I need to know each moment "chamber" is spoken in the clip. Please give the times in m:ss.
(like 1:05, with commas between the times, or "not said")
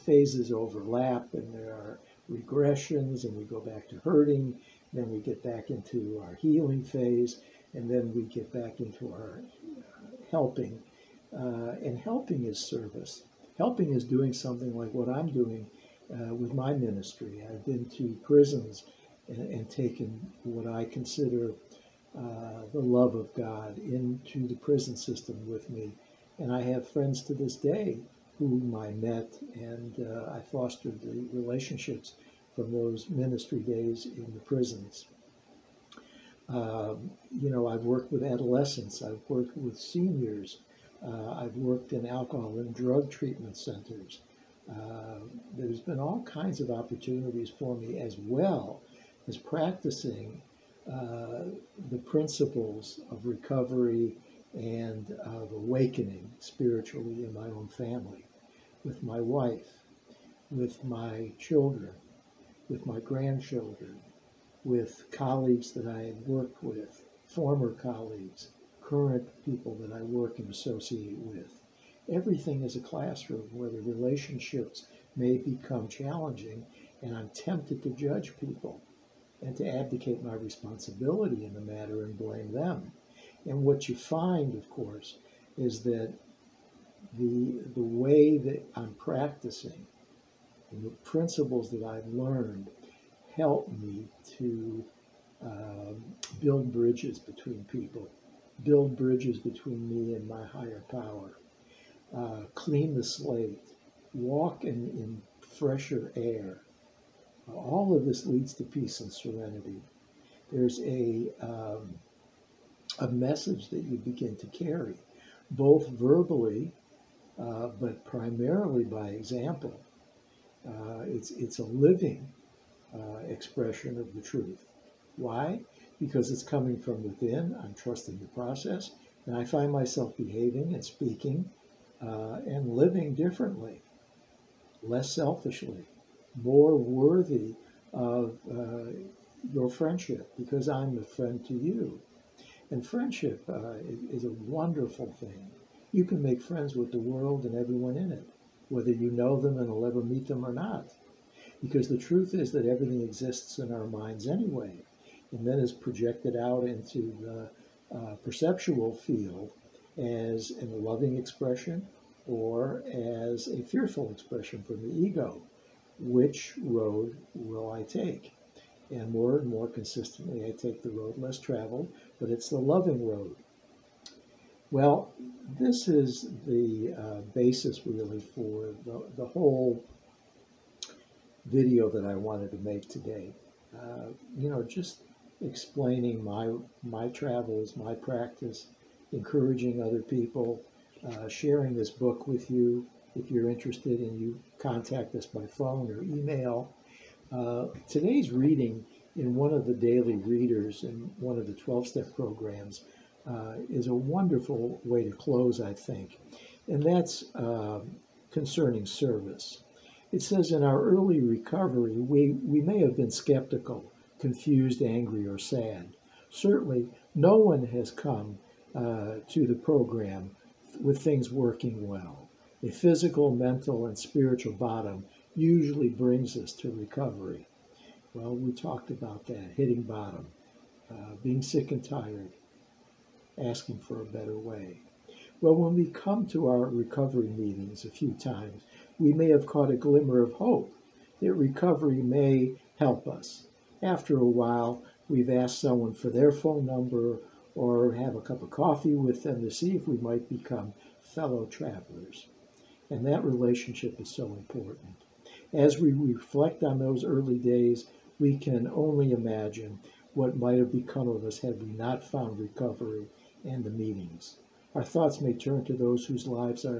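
not said.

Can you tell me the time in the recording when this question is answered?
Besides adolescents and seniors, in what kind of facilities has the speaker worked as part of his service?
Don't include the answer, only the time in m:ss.
0:42.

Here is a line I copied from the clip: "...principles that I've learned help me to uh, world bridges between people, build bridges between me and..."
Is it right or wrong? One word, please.
wrong.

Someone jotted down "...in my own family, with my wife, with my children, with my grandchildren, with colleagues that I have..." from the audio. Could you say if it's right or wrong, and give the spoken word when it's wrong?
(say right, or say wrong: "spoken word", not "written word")
right.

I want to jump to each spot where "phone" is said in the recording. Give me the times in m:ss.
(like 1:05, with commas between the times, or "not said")
3:15, 4:06.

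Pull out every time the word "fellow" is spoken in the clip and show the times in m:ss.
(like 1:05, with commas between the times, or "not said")
4:11.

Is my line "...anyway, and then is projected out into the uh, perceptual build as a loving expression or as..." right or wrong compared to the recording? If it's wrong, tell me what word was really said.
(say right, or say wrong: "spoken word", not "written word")
wrong: "field", not "build".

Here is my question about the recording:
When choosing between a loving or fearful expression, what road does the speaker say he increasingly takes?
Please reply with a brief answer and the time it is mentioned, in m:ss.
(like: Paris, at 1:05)
the road less traveled, at 2:50.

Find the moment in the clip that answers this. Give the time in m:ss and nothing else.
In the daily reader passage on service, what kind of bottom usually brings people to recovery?
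3:42.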